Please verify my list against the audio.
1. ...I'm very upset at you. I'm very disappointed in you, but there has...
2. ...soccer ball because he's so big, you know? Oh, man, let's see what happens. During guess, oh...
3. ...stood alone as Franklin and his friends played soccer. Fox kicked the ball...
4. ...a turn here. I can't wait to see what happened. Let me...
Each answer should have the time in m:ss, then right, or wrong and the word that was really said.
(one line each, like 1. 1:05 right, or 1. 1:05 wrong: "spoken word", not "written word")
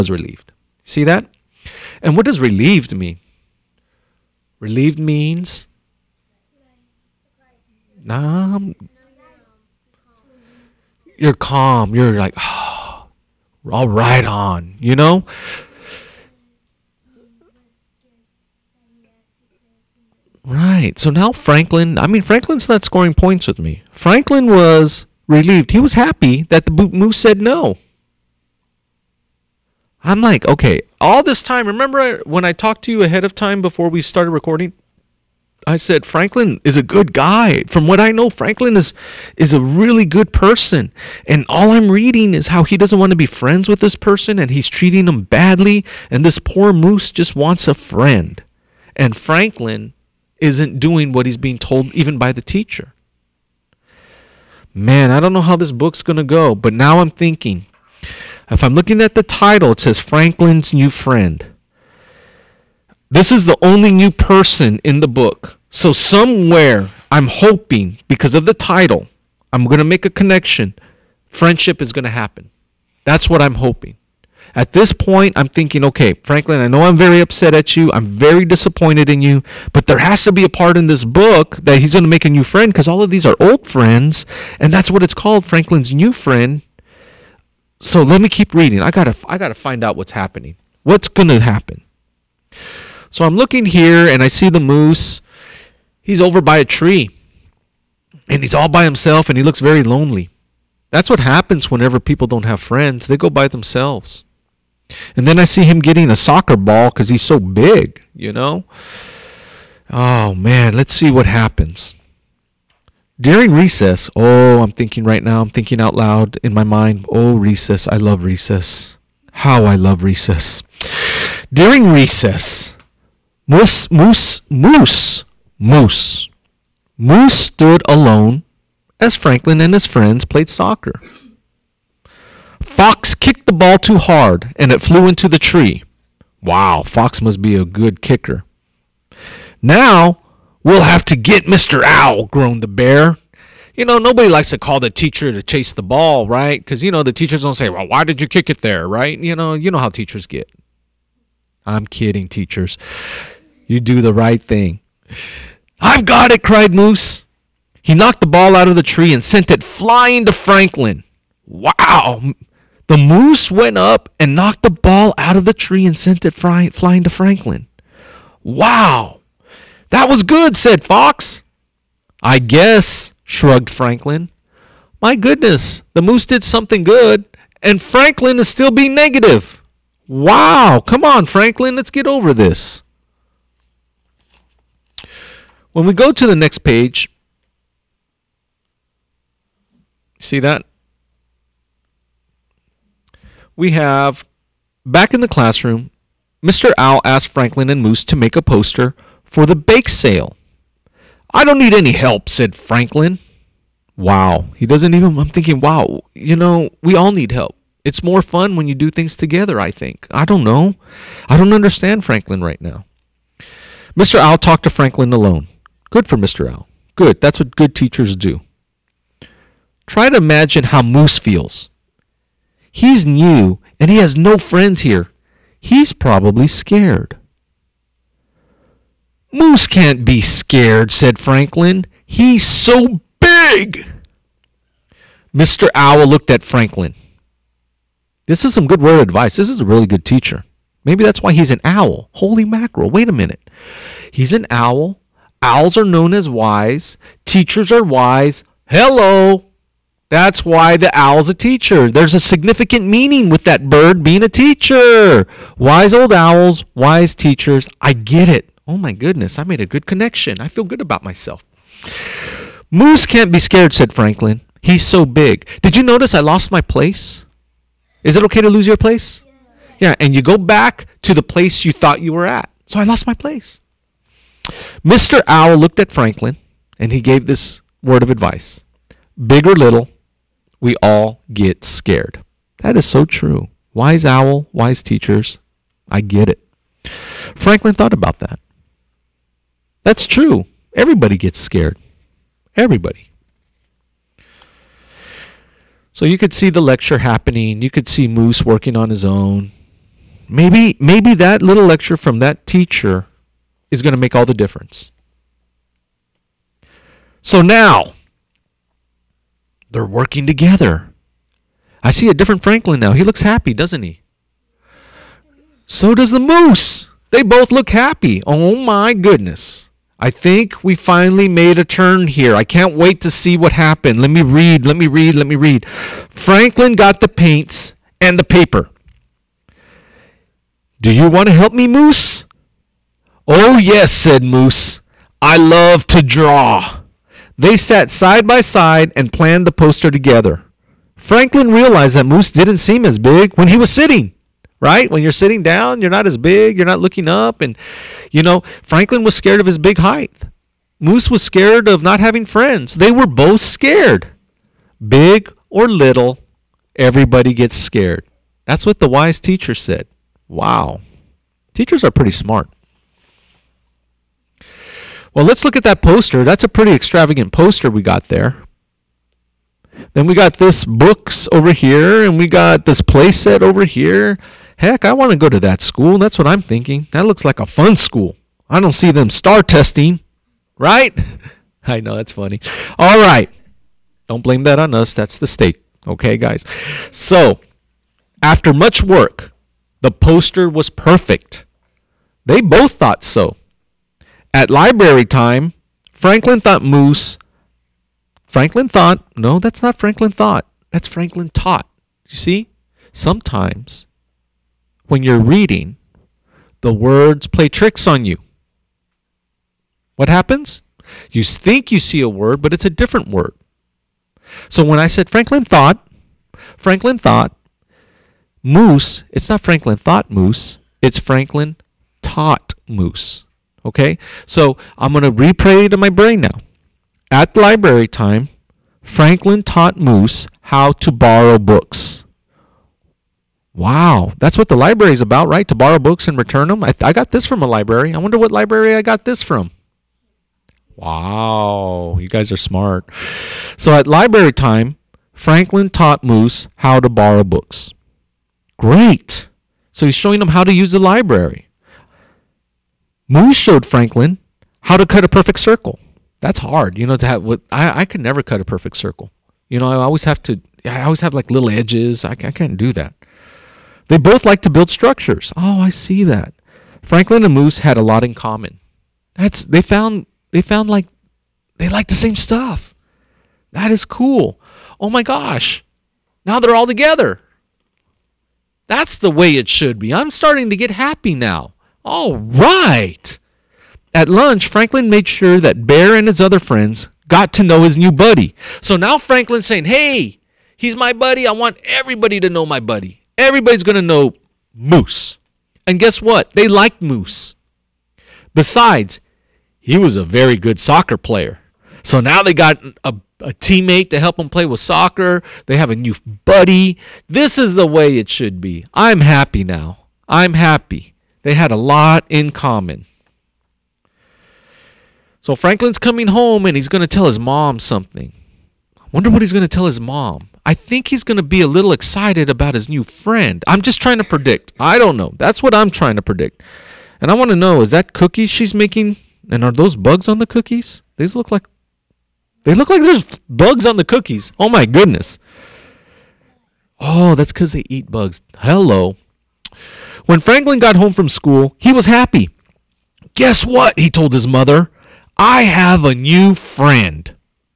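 1. 1:16 right
2. 1:46 wrong: "recess", not "guess"
3. 2:07 right
4. 5:21 right.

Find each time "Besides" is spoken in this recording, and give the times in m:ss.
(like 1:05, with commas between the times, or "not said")
8:18.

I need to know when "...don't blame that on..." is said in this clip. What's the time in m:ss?
6:24.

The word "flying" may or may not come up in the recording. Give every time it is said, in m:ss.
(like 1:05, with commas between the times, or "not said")
2:39, 2:46.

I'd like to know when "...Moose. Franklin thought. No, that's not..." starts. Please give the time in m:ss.
6:36.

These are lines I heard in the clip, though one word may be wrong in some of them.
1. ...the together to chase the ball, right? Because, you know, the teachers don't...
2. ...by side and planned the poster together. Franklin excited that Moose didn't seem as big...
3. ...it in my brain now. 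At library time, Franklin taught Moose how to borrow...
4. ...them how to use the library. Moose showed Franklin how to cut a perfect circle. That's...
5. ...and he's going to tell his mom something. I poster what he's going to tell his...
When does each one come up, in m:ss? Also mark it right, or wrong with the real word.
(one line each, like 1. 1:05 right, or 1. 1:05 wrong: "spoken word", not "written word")
1. 2:24 wrong: "teacher", not "together"
2. 5:38 wrong: "realized", not "excited"
3. 7:05 right
4. 7:30 right
5. 8:36 wrong: "wonder", not "poster".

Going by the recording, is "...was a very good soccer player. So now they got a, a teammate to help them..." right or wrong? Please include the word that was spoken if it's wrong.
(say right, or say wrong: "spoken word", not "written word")
right.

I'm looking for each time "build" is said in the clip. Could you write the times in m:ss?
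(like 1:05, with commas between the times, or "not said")
7:44.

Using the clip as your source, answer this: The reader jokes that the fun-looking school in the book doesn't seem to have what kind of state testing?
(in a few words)
STAAR testing.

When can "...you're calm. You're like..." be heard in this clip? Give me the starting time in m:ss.
0:11.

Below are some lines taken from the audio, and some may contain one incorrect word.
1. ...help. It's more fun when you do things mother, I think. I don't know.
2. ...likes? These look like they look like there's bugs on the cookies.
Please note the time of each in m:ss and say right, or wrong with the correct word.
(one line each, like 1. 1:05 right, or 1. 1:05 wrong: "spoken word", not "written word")
1. 3:27 wrong: "together", not "mother"
2. 8:50 wrong: "cookies", not "likes".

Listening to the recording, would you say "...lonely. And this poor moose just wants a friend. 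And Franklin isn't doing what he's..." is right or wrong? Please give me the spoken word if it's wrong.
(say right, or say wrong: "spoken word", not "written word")
wrong: "badly", not "lonely".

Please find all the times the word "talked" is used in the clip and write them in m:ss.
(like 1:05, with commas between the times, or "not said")
0:32, 3:34.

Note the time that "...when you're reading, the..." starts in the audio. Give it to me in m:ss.
6:44.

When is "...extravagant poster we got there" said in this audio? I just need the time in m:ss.
6:06.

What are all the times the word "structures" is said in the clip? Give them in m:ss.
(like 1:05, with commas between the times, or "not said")
7:44.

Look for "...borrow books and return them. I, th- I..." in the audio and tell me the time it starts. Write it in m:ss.
7:15.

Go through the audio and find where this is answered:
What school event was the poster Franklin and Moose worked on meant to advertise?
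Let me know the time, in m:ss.
3:19.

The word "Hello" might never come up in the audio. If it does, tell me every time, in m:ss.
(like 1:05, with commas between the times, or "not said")
4:08, 8:58.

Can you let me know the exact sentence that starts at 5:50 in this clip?
Moose was scared of not having friends.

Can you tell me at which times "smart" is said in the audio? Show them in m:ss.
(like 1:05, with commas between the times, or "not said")
6:02, 7:22.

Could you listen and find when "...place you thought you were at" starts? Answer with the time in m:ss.
4:31.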